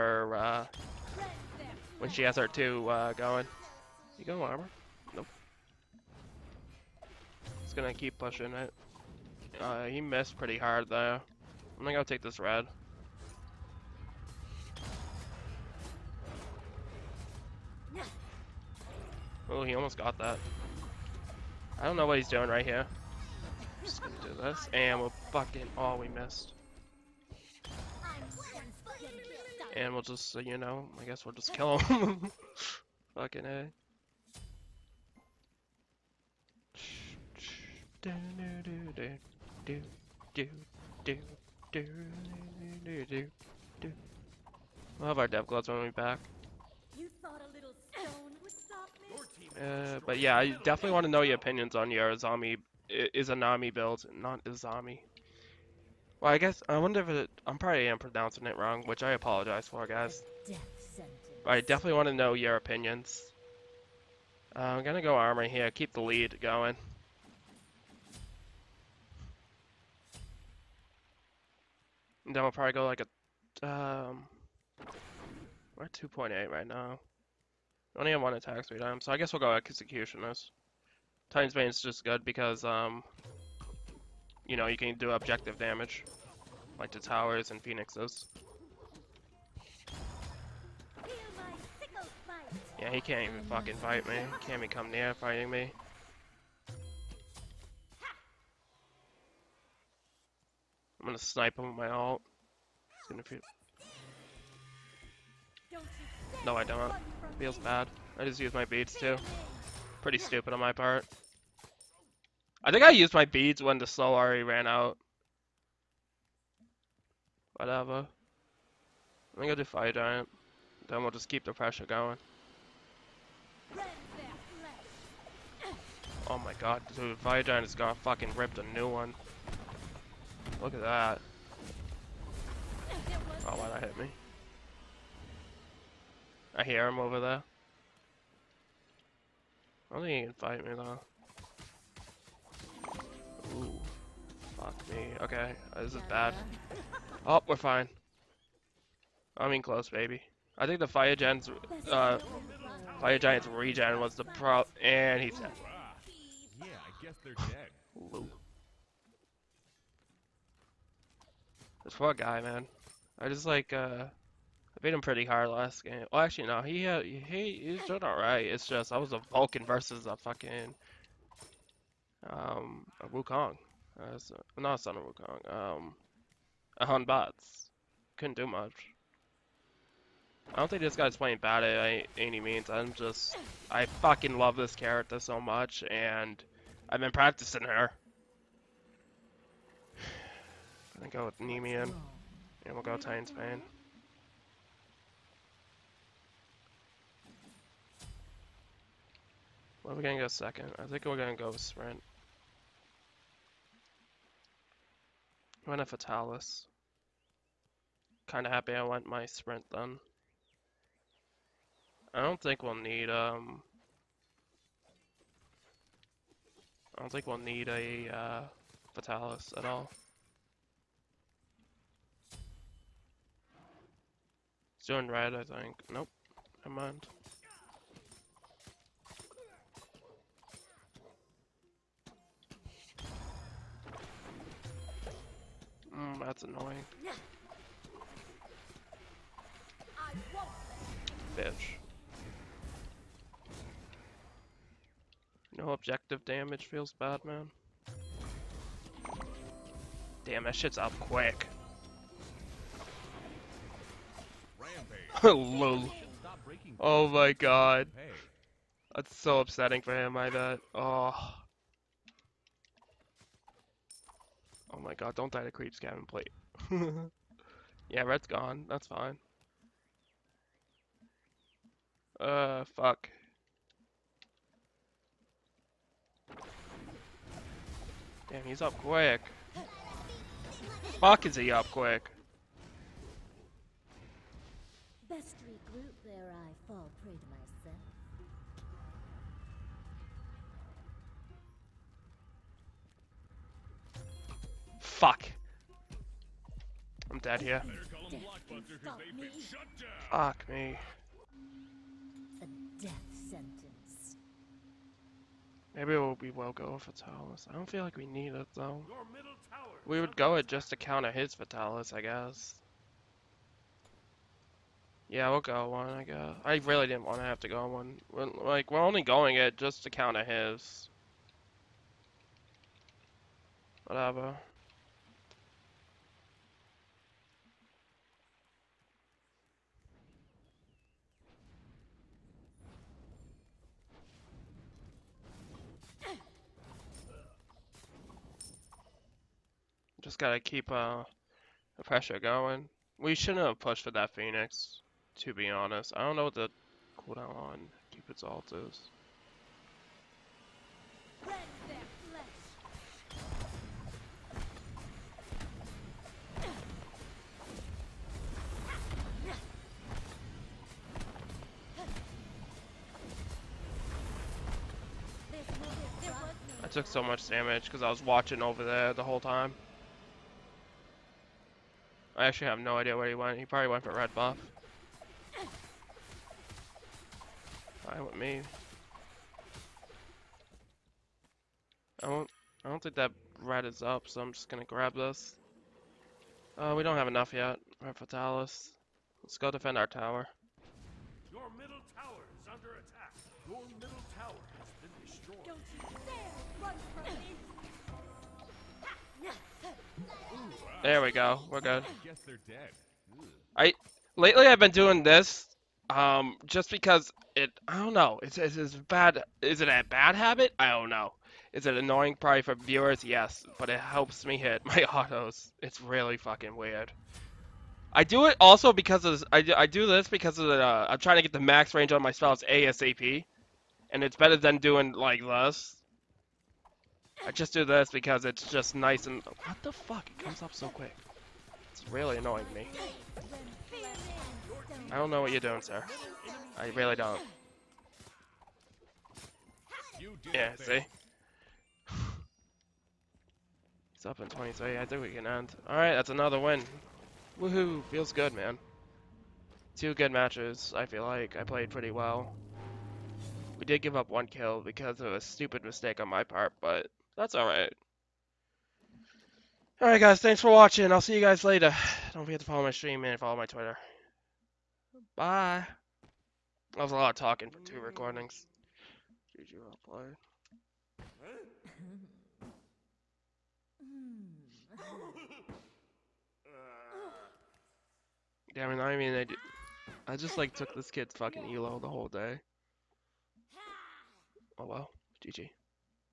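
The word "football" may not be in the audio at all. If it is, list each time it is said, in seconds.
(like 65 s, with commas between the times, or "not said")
not said.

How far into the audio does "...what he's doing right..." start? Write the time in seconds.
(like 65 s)
22 s.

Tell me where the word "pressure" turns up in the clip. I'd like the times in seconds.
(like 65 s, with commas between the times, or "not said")
121 s, 341 s.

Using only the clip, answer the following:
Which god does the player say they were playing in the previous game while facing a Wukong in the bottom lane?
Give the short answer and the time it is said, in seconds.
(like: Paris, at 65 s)
Vulcan, at 169 s.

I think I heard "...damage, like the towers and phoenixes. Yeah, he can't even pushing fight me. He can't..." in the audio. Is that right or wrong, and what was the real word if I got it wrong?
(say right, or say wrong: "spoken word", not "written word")
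wrong: "fucking", not "pushing".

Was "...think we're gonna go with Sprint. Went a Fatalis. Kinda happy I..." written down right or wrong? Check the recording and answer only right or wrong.
right.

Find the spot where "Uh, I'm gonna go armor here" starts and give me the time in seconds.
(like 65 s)
64 s.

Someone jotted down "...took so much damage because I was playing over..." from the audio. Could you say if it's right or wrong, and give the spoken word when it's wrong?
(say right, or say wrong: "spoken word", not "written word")
wrong: "watching", not "playing".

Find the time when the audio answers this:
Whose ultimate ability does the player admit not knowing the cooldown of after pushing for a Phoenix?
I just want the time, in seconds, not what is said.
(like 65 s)
347 s.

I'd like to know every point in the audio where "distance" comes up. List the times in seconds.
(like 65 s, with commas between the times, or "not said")
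not said.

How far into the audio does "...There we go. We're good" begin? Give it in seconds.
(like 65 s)
400 s.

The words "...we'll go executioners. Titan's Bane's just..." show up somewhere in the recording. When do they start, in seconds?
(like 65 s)
79 s.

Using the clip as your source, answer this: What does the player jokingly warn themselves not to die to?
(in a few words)
creep scaven plate.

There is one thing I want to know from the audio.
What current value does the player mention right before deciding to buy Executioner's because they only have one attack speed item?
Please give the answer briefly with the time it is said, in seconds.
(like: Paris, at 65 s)
2.8, at 75 s.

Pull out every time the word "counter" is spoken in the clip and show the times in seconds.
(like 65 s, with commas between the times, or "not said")
310 s, 319 s.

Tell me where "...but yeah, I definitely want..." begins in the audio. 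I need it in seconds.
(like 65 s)
50 s.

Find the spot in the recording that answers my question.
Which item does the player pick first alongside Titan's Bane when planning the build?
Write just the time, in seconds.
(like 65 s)
191 s.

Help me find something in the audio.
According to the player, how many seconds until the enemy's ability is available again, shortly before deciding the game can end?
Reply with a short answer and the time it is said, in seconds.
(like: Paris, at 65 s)
23, at 444 s.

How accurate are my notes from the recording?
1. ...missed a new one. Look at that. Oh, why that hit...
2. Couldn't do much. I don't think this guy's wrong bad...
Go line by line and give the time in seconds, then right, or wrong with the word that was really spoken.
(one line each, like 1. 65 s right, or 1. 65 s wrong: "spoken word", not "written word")
1. 128 s wrong: "ripped", not "missed"
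2. 178 s wrong: "playing", not "wrong".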